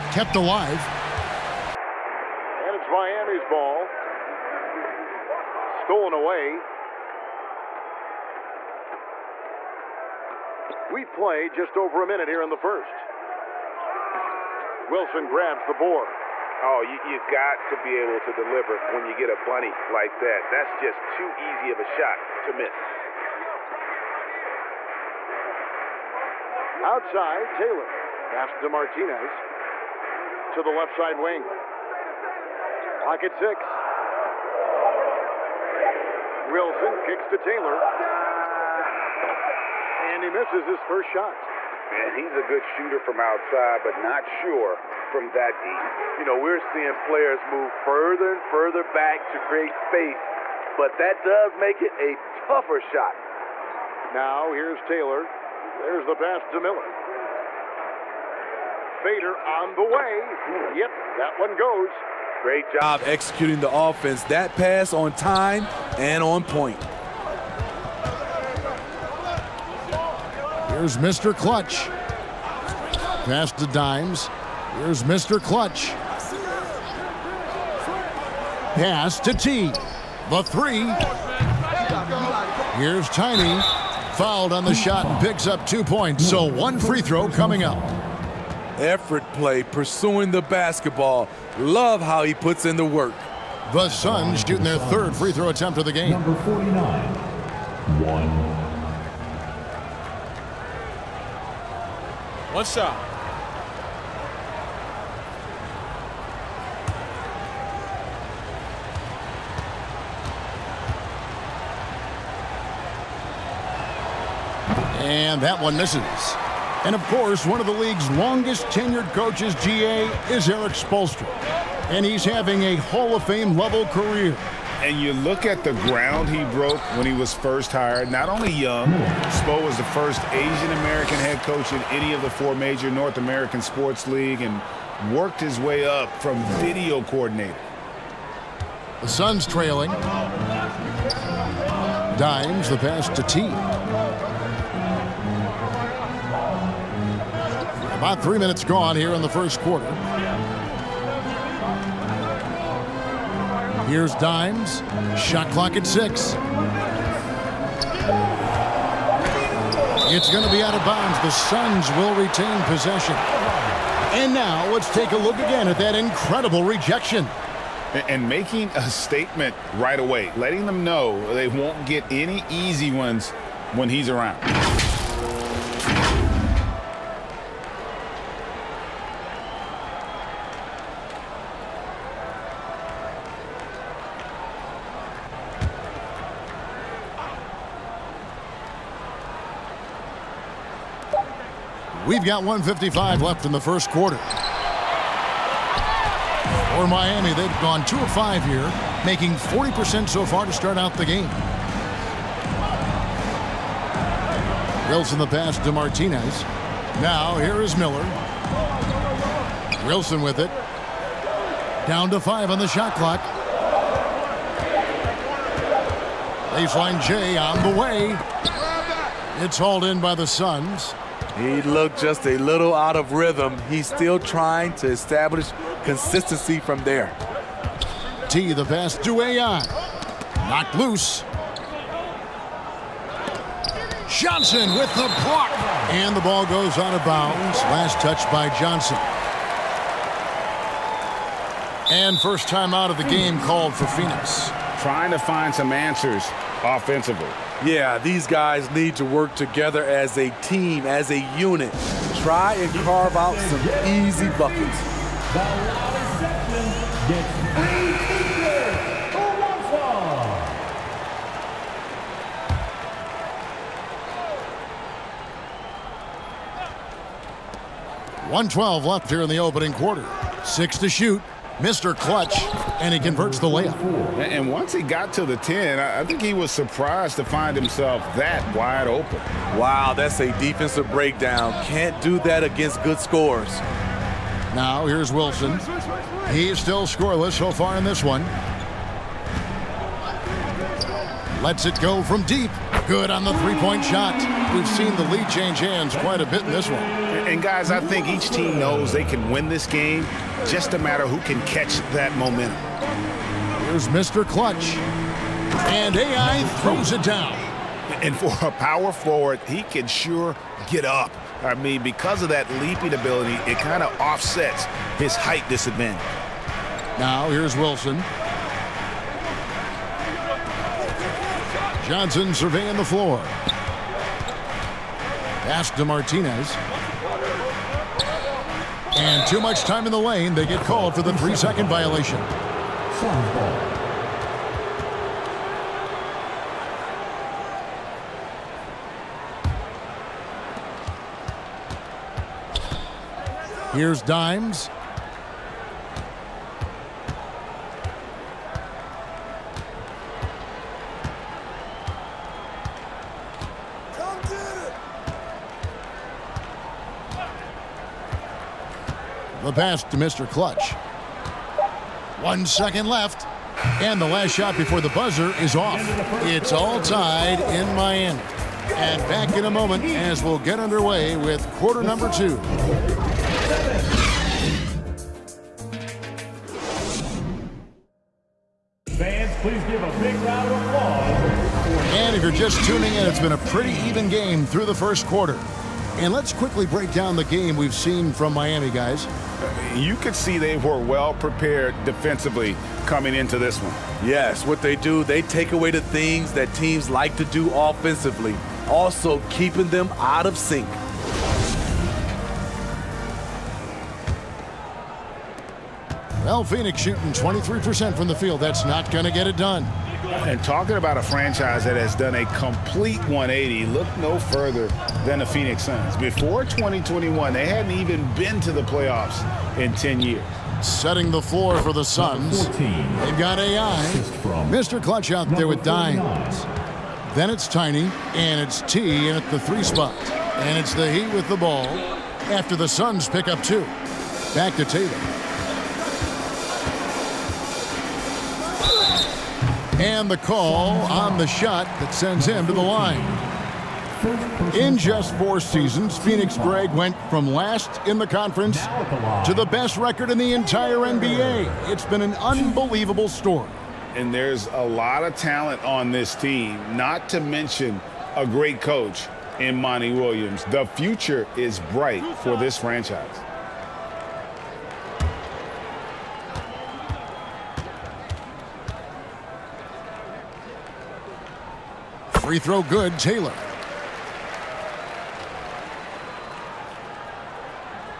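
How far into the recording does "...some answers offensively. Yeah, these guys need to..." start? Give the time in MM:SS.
04:05.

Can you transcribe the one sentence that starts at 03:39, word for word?
It's hauled in by the Suns.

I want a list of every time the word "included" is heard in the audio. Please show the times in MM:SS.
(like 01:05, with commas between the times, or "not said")
not said.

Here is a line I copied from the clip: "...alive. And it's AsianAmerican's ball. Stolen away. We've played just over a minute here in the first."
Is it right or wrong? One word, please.
wrong.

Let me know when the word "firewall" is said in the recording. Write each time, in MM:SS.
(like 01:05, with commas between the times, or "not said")
not said.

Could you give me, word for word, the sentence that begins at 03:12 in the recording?
We've got 155 left in the first quarter.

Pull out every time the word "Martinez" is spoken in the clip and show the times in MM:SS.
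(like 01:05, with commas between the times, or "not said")
00:28, 03:25, 05:25.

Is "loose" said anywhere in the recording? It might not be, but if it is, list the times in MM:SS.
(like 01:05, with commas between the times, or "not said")
03:50.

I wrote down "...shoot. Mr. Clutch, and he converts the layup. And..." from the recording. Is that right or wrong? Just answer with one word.
right.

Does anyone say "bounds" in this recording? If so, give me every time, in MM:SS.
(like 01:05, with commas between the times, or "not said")
02:40, 03:57.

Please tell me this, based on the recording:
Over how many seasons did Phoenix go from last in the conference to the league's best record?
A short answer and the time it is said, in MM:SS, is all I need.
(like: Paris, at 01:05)
4, at 07:25.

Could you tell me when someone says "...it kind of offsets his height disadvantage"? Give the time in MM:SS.
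05:13.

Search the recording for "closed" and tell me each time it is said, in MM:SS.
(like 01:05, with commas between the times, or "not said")
not said.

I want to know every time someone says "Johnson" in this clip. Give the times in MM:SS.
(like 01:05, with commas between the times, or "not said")
03:54, 03:58, 05:21.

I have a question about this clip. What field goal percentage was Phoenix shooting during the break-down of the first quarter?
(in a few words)
23%.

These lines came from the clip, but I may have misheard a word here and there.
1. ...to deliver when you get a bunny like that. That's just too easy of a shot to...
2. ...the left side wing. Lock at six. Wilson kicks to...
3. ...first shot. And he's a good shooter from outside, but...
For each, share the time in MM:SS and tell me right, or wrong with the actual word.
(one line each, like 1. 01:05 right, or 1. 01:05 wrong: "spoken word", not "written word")
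1. 00:18 right
2. 00:30 right
3. 00:40 right.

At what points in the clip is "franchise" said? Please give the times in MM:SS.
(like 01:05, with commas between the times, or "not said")
06:51, 07:42.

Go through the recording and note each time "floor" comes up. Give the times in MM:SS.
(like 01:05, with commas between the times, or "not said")
05:22, 07:01.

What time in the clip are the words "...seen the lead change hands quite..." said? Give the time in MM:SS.
04:54.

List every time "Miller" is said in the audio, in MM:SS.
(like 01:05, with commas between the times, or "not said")
00:56, 03:27.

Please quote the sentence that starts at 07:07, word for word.
Then it's Tiny, and it's T in at the three spot.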